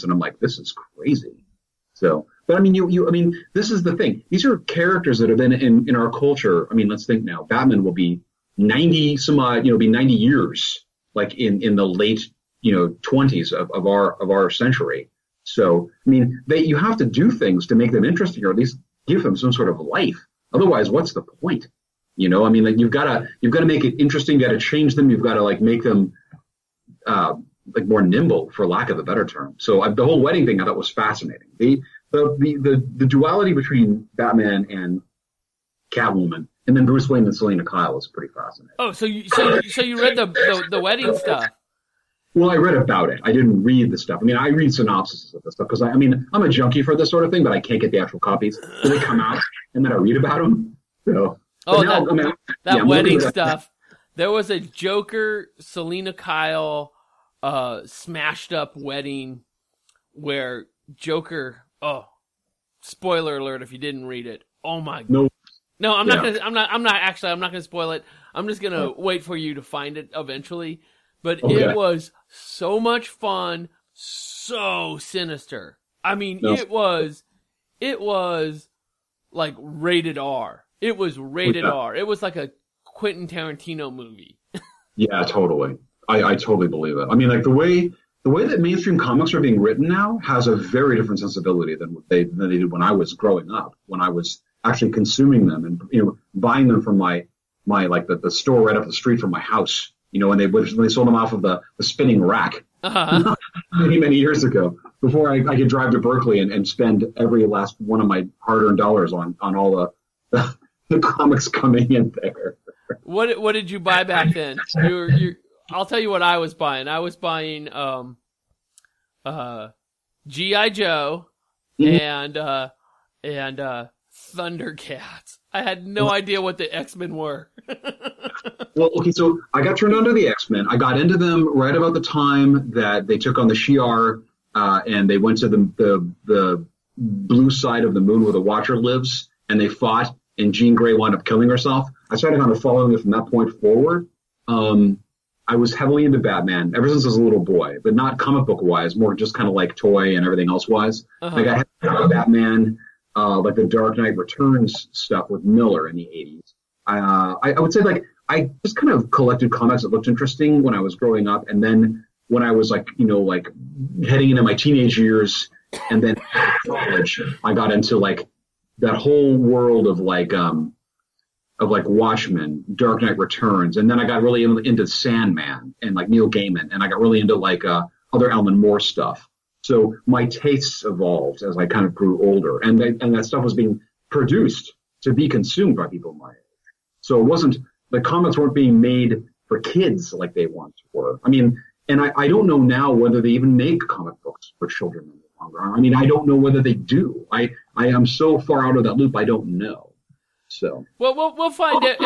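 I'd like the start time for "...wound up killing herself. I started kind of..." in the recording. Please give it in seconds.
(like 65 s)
140 s.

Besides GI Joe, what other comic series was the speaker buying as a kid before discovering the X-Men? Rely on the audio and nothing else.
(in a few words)
Thundercats.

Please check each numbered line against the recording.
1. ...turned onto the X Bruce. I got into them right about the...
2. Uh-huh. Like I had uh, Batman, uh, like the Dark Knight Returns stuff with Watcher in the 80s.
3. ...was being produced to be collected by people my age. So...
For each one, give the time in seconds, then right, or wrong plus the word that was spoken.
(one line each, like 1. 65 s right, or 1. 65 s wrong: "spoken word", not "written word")
1. 129 s wrong: "Men", not "Bruce"
2. 151 s wrong: "Miller", not "Watcher"
3. 183 s wrong: "consumed", not "collected".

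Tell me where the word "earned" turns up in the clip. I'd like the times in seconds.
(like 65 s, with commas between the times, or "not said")
108 s.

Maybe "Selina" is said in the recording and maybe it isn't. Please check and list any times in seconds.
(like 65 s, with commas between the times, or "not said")
37 s, 55 s.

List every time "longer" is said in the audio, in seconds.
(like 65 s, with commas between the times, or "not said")
195 s.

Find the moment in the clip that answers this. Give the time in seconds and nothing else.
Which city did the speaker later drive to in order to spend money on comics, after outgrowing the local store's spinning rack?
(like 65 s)
105 s.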